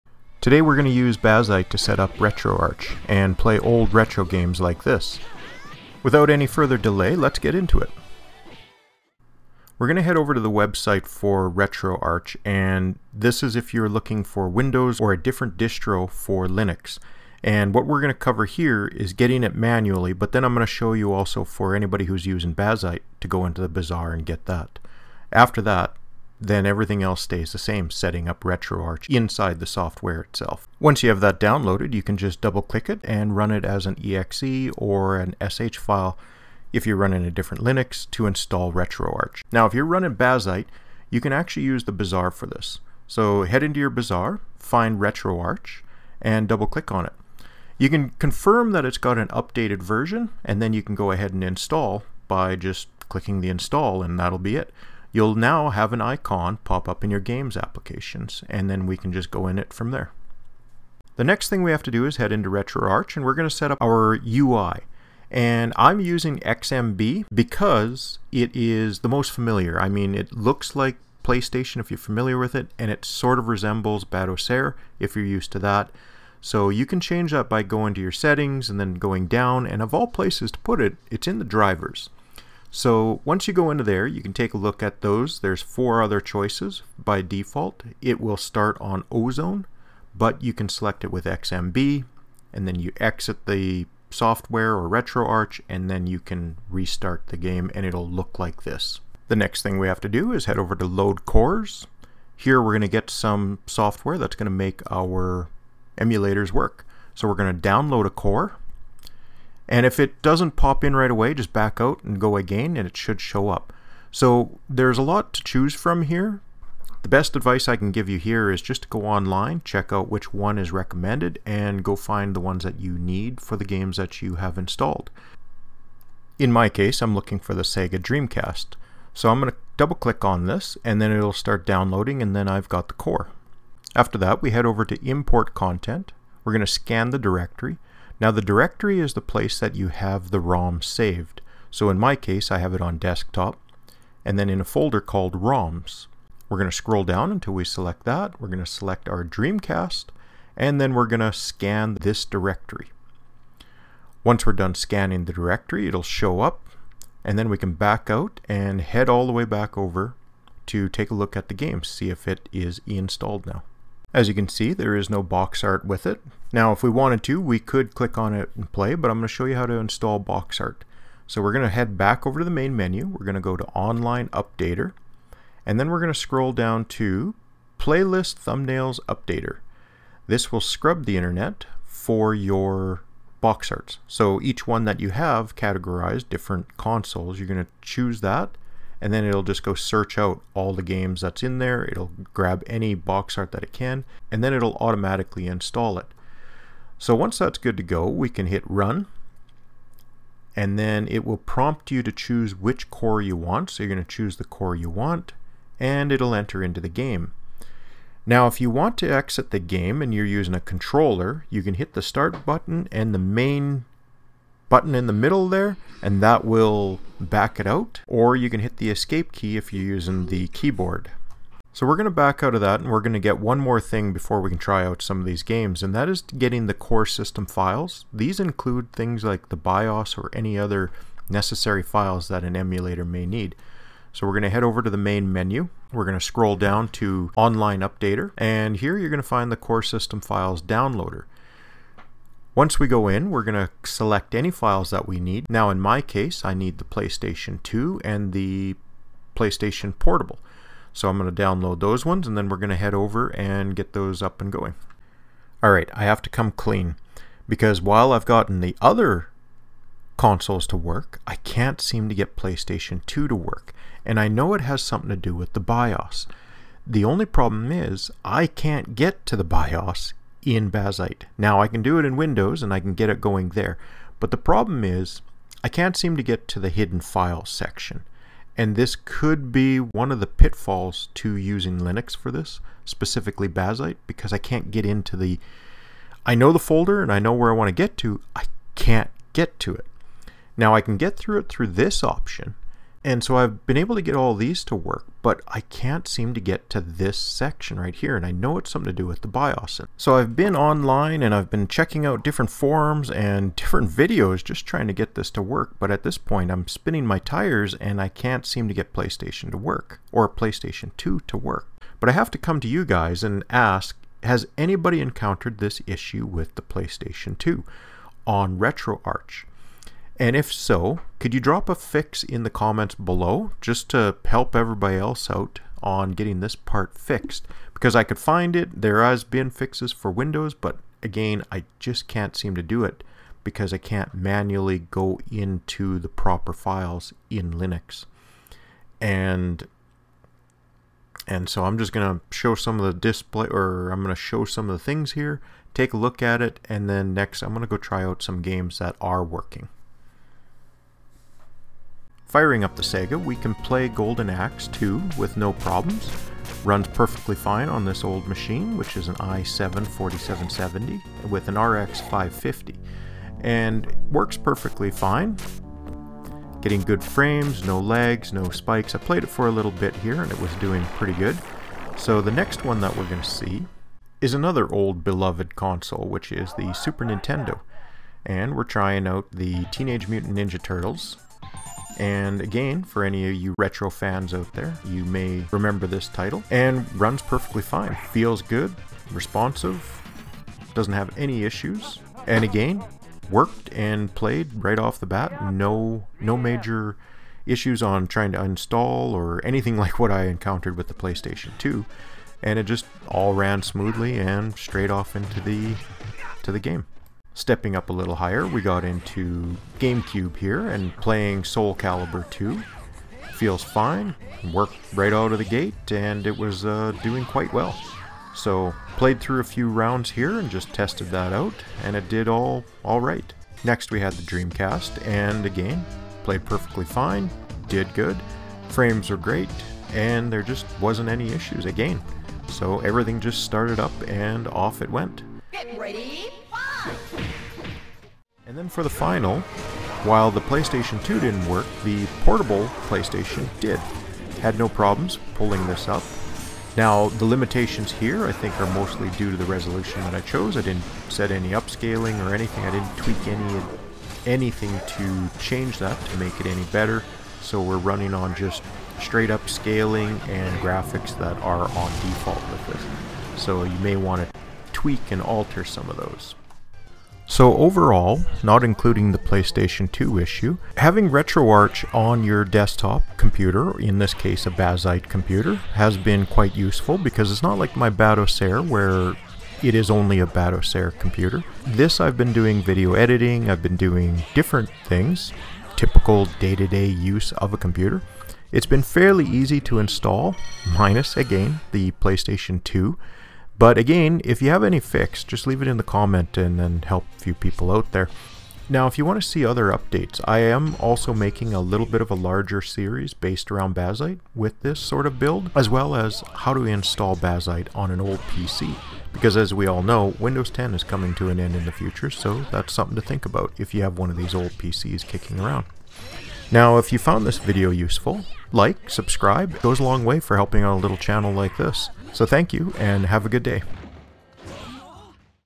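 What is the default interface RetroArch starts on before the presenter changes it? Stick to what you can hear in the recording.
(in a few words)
Ozone.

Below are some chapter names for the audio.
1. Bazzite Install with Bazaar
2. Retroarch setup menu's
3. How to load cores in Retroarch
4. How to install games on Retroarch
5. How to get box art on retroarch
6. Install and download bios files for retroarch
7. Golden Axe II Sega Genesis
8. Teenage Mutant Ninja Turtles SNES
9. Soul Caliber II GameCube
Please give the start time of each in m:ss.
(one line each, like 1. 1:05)
1. 0:38
2. 1:00
3. 1:40
4. 2:13
5. 2:48
6. 3:45
7. 5:52
8. 6:14
9. 6:47.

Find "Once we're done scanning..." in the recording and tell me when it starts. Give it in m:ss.
2:34.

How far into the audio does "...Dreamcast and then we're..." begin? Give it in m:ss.
2:29.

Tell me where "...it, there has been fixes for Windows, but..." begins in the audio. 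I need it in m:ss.
5:28.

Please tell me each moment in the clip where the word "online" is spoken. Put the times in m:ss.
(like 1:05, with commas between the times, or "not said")
1:59, 2:53, 3:57, 5:00.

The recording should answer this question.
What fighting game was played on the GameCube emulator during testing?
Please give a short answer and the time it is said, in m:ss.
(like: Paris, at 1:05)
Soul Calibur 2, at 6:51.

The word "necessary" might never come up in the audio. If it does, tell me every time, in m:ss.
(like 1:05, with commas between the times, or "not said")
3:51.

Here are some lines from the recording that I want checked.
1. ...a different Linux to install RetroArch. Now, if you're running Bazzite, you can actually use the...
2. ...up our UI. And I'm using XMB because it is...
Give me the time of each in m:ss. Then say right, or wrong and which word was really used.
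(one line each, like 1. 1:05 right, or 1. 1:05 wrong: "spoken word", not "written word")
1. 0:37 right
2. 1:03 right.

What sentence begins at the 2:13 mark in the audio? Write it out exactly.
After that, we head over to import content.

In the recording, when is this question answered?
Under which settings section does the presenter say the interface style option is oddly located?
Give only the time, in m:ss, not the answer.
1:21.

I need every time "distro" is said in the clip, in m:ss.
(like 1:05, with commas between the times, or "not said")
0:15.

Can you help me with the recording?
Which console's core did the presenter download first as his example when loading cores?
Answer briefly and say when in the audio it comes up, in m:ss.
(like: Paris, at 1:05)
Sega Dreamcast, at 2:07.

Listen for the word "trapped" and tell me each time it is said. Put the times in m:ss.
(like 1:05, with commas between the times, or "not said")
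not said.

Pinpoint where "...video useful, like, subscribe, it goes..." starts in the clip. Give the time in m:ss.
8:37.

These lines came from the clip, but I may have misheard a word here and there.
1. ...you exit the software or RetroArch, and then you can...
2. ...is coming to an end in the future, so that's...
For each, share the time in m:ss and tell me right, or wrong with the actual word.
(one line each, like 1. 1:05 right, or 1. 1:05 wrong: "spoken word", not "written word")
1. 1:32 right
2. 8:30 right.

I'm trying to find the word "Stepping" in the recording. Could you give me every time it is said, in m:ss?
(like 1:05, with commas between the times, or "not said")
6:47.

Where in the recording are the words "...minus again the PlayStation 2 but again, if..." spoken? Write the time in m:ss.
8:10.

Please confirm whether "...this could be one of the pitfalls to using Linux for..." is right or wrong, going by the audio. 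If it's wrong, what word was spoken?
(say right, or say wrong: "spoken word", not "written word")
right.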